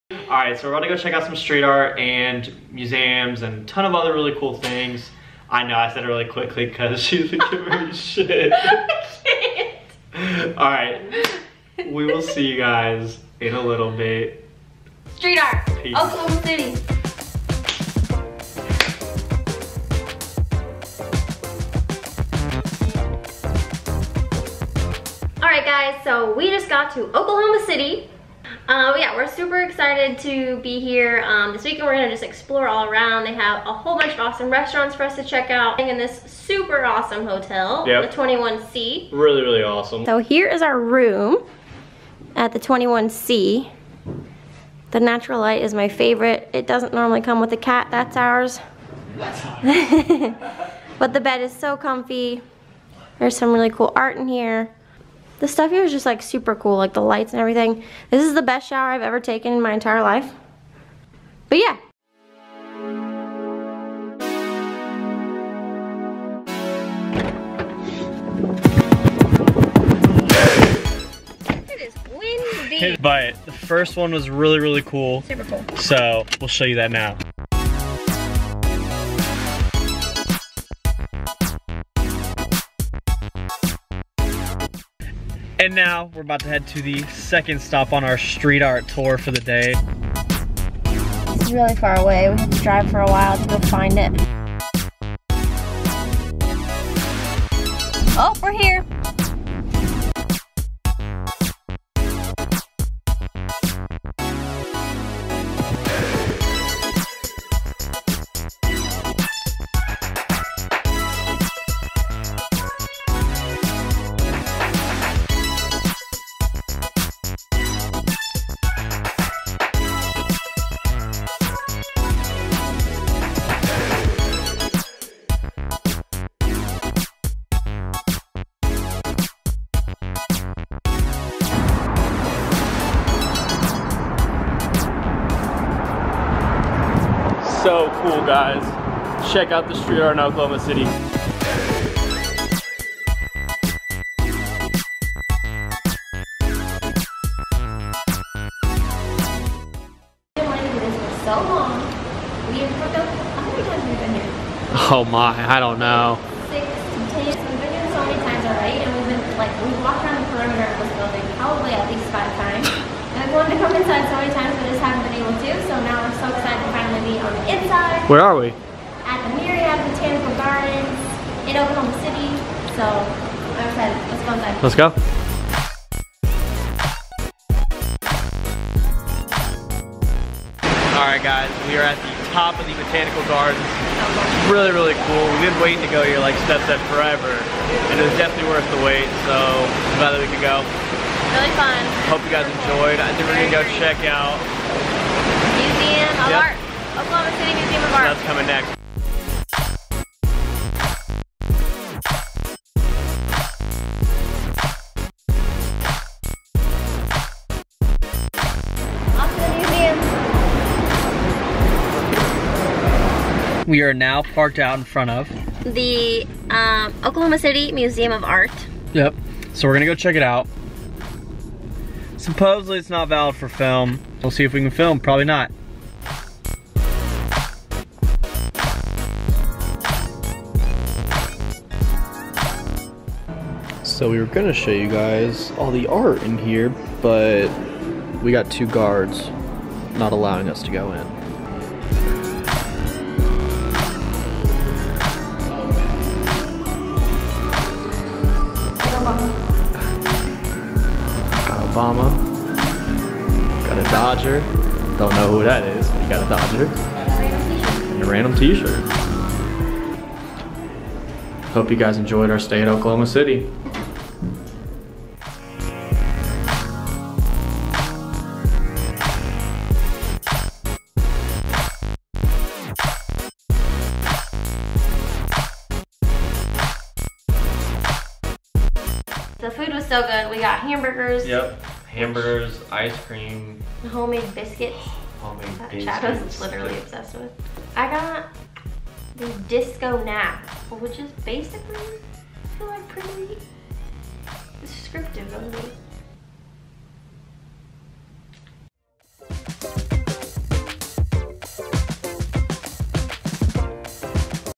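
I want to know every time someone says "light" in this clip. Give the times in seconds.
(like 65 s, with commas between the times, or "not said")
45 s, 57 s.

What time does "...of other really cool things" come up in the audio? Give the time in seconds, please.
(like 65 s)
3 s.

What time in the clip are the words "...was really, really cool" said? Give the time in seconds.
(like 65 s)
74 s.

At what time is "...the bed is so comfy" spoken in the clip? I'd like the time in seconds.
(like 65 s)
51 s.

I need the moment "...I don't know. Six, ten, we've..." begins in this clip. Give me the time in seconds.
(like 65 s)
155 s.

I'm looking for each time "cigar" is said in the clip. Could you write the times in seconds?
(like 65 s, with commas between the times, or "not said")
not said.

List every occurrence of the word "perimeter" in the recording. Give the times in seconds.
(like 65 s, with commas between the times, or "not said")
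160 s.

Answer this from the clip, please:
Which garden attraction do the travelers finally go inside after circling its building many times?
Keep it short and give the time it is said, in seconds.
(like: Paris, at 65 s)
Myriad Botanical Gardens, at 169 s.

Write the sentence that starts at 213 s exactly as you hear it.
We are now parked out in front of the um, Oklahoma City Museum of Art.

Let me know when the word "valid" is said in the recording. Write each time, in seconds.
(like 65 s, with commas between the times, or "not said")
223 s.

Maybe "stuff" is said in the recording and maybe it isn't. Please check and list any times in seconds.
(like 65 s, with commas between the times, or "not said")
55 s.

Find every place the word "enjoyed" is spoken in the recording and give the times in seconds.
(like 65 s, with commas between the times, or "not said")
192 s, 261 s.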